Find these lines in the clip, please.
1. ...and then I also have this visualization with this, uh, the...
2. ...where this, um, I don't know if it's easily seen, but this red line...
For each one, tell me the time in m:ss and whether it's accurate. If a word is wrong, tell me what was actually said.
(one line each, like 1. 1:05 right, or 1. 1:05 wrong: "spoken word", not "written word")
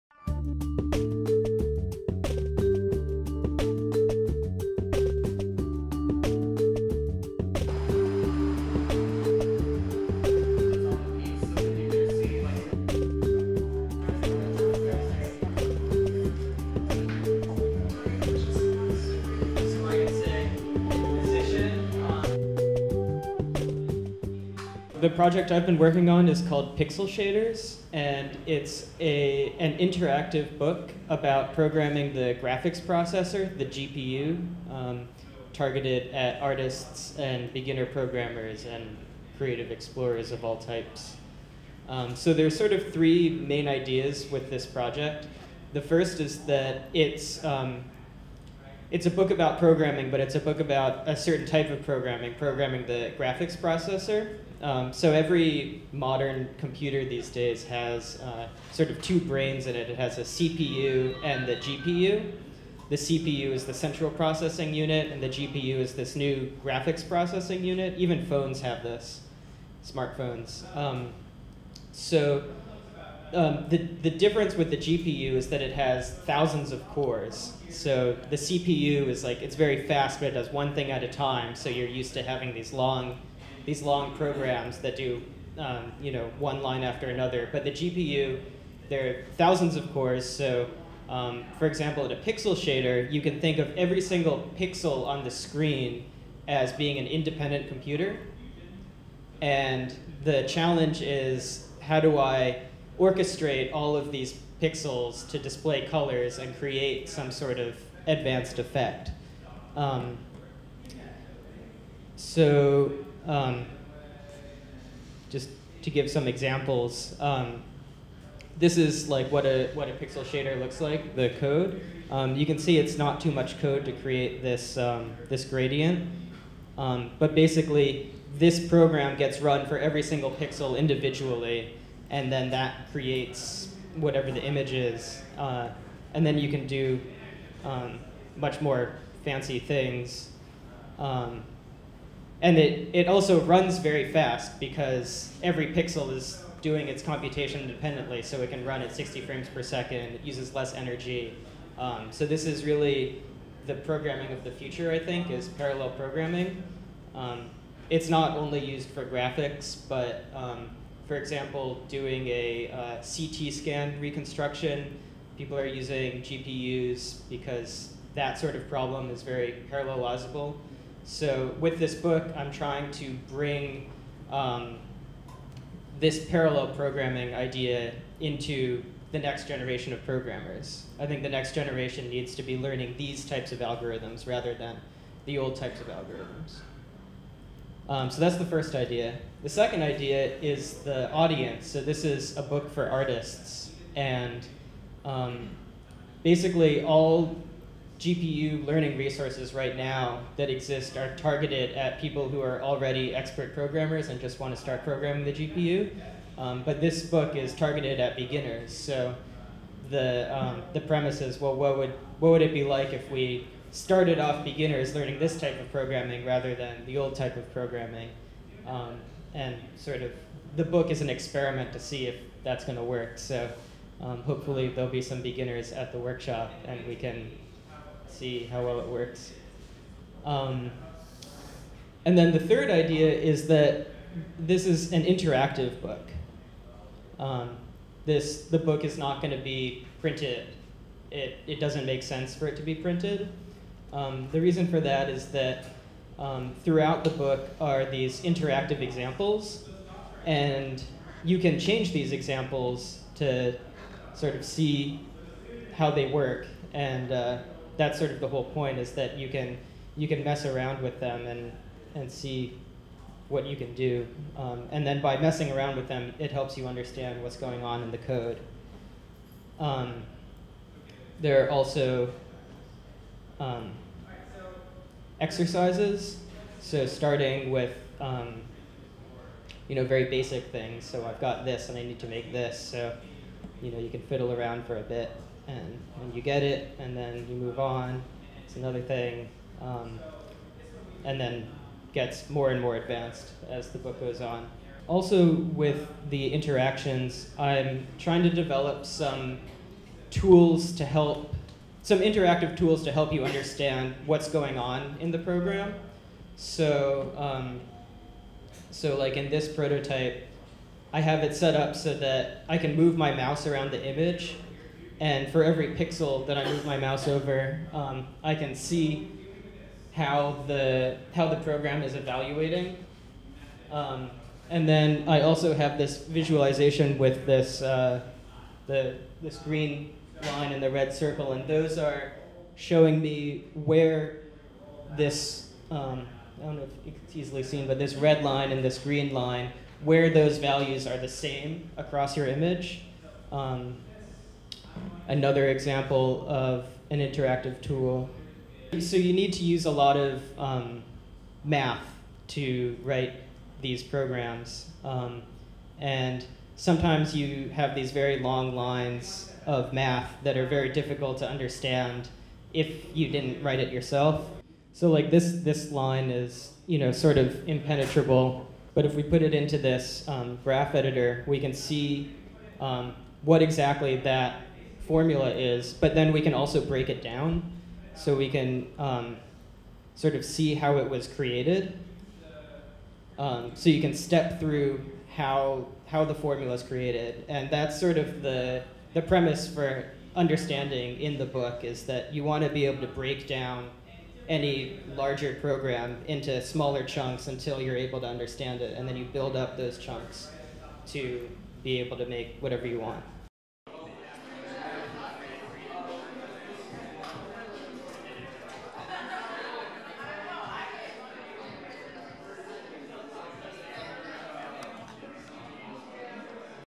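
1. 5:24 right
2. 5:33 right.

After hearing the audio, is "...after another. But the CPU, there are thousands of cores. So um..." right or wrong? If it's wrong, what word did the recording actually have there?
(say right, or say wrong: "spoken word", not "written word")
wrong: "GPU", not "CPU".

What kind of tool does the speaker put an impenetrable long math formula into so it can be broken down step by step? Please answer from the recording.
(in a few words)
graph editor.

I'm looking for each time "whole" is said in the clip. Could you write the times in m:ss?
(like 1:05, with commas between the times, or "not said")
4:18.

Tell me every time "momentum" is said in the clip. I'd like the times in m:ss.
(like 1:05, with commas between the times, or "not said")
not said.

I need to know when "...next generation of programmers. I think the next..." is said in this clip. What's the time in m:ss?
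2:59.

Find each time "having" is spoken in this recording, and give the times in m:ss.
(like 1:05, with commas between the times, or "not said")
1:22.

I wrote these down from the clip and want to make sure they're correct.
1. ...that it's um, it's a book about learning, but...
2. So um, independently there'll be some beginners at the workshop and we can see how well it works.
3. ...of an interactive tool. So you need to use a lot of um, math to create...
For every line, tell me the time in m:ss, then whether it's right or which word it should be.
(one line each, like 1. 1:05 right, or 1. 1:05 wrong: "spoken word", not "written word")
1. 0:46 wrong: "programming", not "learning"
2. 3:43 wrong: "hopefully", not "independently"
3. 5:46 wrong: "write", not "create".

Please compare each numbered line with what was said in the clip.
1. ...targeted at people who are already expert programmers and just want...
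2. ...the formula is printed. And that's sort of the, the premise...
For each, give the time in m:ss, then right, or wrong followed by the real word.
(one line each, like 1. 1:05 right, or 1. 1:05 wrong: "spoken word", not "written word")
1. 3:21 right
2. 6:26 wrong: "created", not "printed".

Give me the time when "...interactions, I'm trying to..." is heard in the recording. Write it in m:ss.
4:56.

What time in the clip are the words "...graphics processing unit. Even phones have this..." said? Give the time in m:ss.
1:06.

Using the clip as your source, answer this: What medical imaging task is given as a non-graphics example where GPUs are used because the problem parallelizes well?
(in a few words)
CT scan reconstruction.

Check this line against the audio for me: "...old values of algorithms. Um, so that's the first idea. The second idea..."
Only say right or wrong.
wrong.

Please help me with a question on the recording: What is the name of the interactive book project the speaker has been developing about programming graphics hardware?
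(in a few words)
Pixel Shaders.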